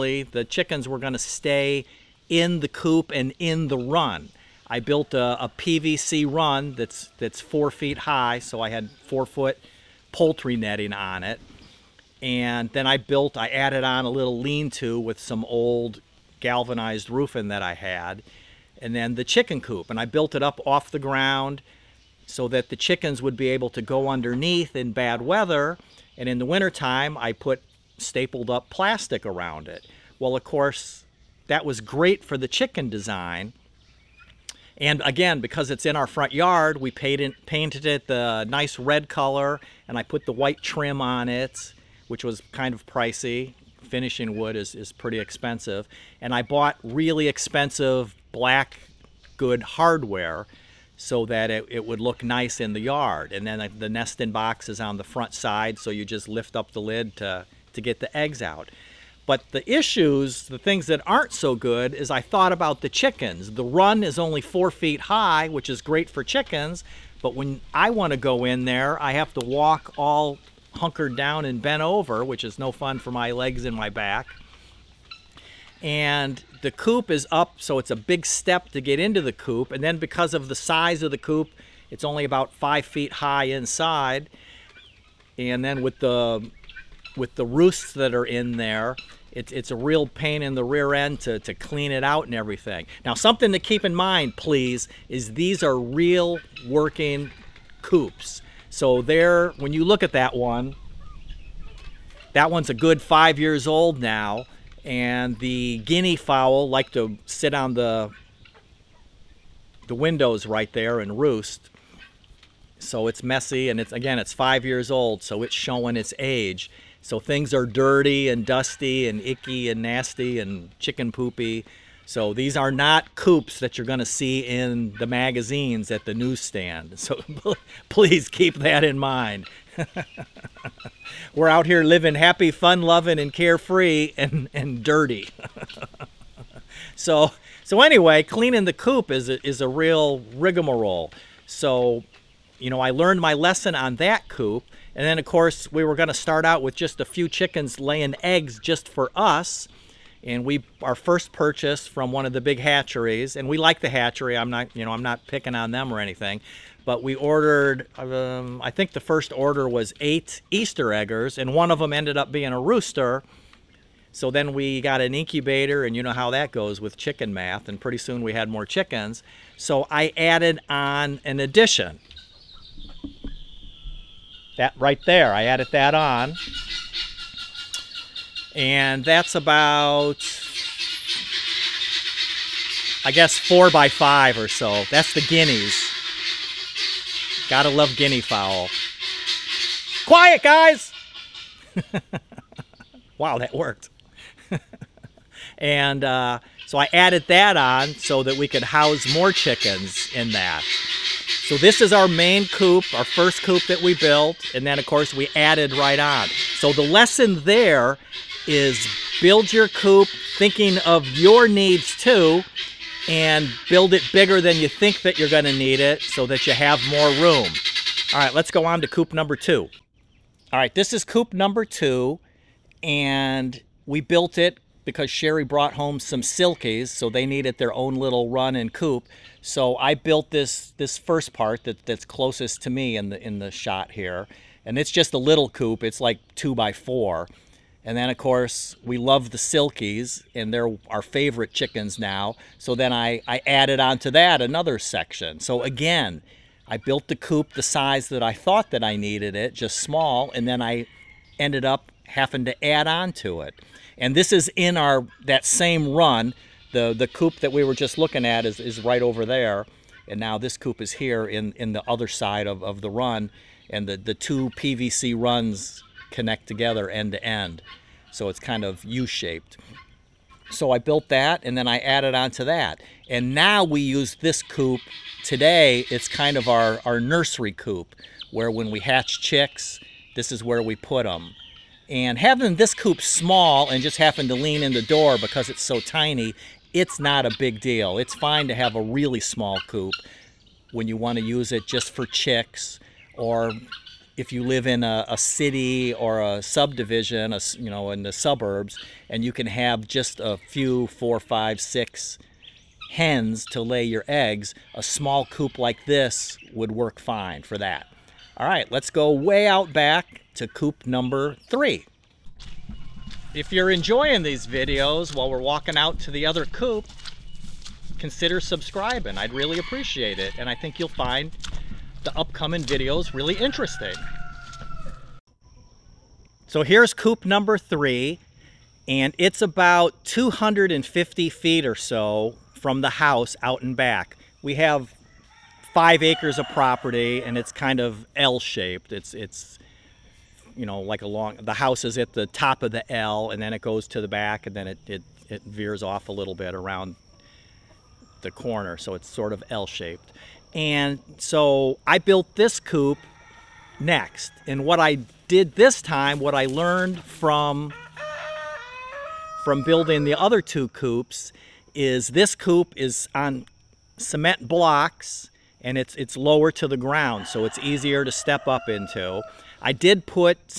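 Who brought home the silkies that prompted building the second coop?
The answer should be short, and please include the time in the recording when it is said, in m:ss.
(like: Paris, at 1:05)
Sherry, at 3:45.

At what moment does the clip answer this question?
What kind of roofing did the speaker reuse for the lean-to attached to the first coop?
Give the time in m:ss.
0:15.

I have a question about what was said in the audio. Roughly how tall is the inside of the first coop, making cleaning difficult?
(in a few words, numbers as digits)
5 feet.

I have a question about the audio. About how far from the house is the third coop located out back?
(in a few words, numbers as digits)
250 feet.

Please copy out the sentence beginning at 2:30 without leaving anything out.
And we, our first purchase from one of the big hatcheries, and we like the hatchery.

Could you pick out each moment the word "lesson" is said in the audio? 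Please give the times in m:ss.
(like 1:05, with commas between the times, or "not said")
2:23, 3:26.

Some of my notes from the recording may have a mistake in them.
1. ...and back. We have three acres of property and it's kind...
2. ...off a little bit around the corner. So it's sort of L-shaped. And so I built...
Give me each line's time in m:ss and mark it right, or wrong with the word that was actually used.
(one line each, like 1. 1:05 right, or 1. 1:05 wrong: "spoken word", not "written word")
1. 5:33 wrong: "five", not "three"
2. 5:45 right.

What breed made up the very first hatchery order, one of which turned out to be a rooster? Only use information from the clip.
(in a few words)
Easter eggers.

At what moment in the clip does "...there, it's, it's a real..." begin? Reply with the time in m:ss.
1:28.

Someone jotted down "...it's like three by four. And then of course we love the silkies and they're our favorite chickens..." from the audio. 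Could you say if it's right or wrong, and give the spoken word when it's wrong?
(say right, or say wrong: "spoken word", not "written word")
wrong: "two", not "three".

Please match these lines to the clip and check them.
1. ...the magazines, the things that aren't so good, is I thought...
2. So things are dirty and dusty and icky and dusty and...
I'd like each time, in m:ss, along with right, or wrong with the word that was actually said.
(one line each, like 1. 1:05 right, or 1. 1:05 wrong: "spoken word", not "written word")
1. 0:59 wrong: "issues", not "magazines"
2. 1:57 wrong: "nasty", not "dusty".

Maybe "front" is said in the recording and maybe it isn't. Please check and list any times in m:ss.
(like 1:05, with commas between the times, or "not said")
0:36, 0:55.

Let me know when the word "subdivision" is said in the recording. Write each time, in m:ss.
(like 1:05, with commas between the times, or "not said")
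4:56.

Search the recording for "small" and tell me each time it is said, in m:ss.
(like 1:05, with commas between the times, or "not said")
4:09, 4:43, 4:49, 5:04.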